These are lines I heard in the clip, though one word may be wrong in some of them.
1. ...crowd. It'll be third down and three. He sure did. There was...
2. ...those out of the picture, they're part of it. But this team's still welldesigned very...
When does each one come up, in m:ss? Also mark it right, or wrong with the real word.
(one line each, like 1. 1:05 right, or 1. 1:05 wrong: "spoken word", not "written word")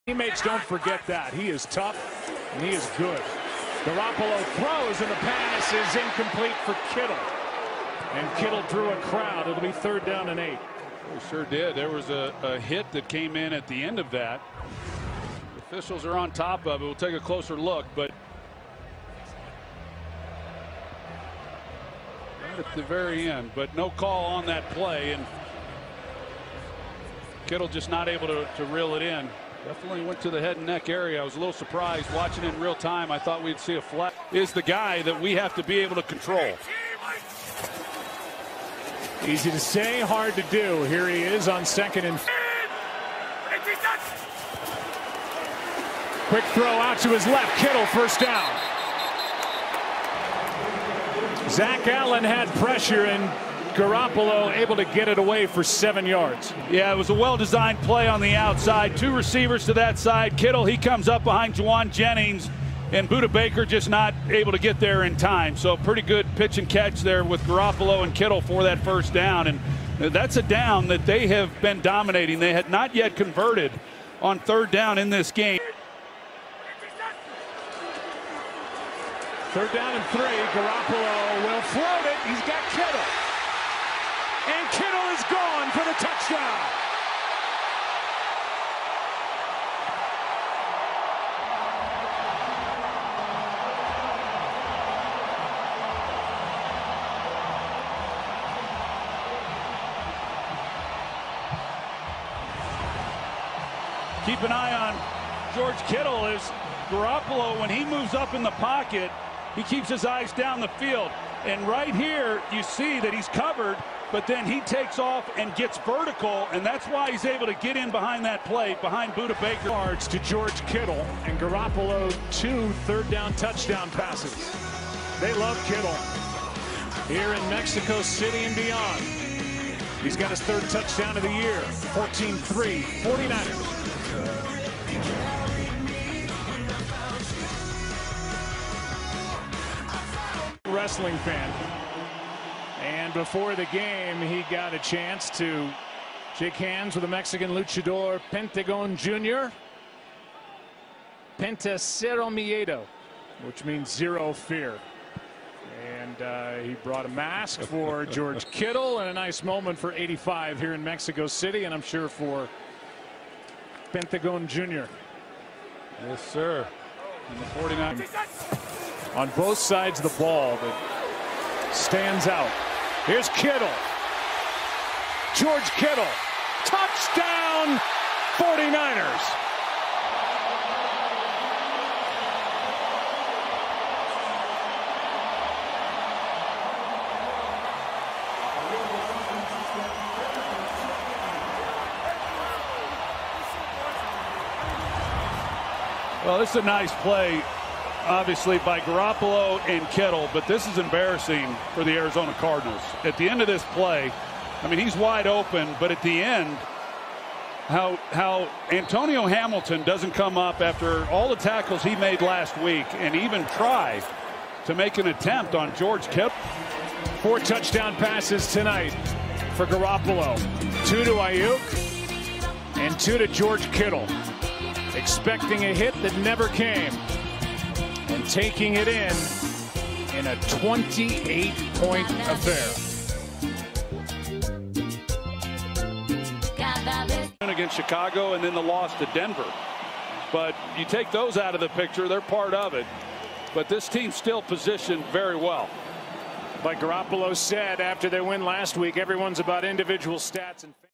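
1. 0:09 wrong: "eight", not "three"
2. 4:01 wrong: "positioned", not "welldesigned".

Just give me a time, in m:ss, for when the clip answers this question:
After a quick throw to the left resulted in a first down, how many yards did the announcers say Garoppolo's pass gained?
0:55.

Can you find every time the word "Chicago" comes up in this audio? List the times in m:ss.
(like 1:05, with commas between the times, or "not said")
3:57.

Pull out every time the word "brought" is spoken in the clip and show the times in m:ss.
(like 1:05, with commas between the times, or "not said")
2:36.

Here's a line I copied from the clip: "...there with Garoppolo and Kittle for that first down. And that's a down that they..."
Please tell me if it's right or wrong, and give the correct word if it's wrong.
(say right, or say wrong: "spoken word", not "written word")
right.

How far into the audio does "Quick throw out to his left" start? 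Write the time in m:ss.
0:46.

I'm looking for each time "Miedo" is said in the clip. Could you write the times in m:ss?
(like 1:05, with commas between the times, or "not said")
2:32.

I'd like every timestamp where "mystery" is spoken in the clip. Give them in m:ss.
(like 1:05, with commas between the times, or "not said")
not said.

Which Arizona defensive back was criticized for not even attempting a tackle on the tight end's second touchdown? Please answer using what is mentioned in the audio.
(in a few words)
Antonio Hamilton.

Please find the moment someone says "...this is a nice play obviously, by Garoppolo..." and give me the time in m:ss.
3:16.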